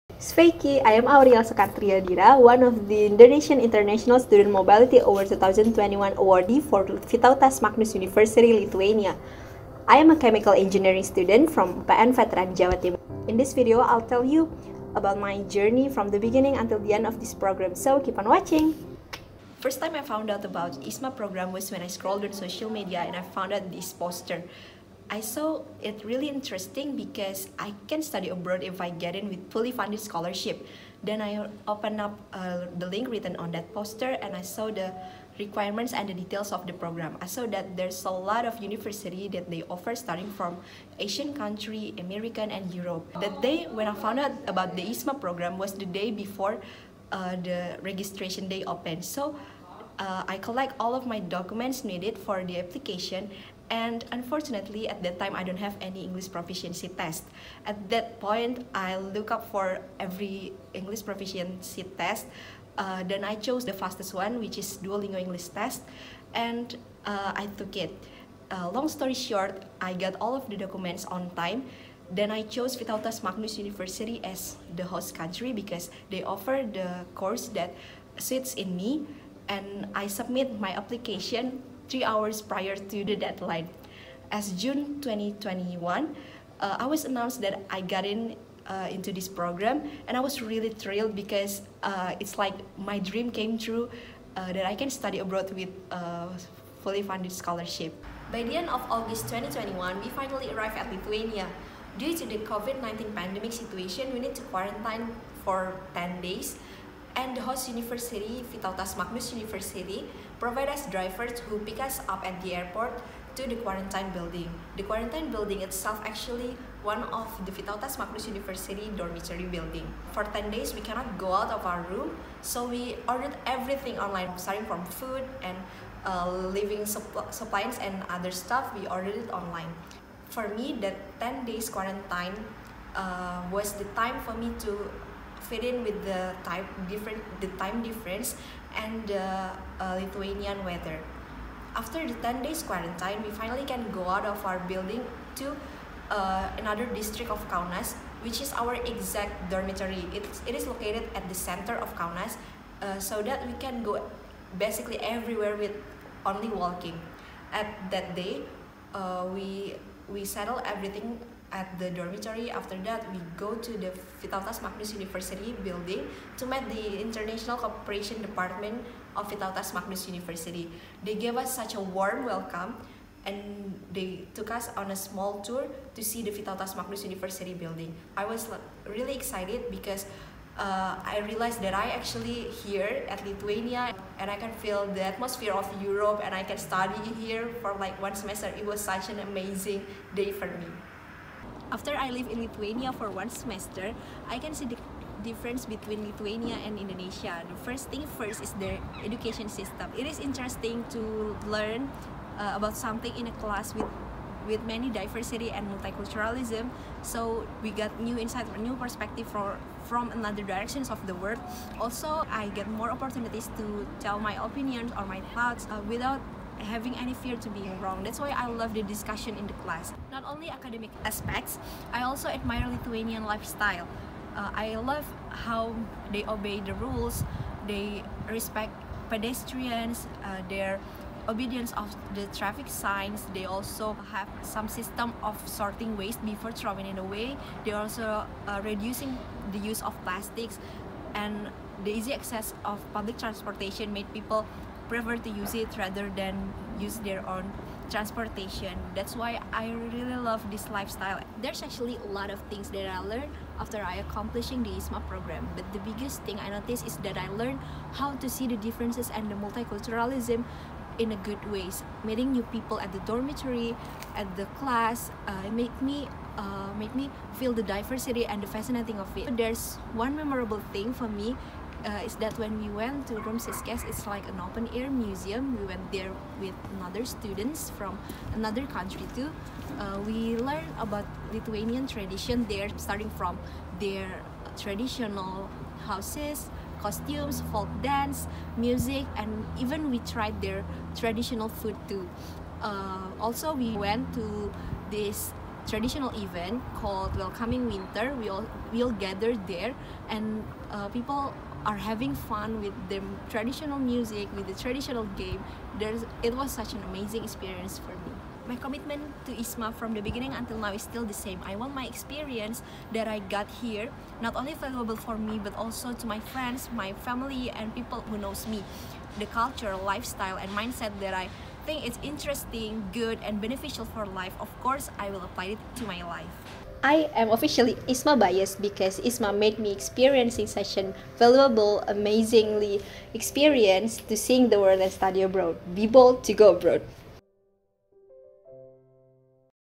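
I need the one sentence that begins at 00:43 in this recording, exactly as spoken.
That day when I found out about the ISMA program was the day before uh, the registration day opened.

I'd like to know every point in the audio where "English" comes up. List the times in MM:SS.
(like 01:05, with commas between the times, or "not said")
00:56, 01:00, 01:05.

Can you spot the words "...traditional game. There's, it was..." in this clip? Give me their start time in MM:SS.
05:04.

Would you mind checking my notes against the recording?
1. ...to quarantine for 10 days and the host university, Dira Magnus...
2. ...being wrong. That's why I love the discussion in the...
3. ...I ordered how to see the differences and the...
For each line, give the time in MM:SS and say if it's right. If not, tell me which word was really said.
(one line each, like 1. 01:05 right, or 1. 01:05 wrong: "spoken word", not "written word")
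1. 01:44 wrong: "Vytautas", not "Dira"
2. 03:37 right
3. 04:17 wrong: "learned", not "ordered".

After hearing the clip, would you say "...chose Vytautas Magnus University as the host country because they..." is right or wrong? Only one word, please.
right.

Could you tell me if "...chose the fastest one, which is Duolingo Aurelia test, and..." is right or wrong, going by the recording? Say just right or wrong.
wrong.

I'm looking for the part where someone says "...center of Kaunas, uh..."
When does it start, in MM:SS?
02:31.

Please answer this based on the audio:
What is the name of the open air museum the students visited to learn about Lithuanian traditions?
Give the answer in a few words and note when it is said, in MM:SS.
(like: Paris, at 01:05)
Rumsiskes, at 04:33.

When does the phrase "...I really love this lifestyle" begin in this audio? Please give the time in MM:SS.
04:09.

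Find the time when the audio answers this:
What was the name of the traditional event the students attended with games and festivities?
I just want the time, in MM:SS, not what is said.
04:57.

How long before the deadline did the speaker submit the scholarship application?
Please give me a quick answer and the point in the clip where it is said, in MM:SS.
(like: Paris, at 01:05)
3 hours, at 01:21.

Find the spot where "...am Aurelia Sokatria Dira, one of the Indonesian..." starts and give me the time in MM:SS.
00:01.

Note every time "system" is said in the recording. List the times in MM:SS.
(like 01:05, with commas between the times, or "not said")
03:19, 03:54.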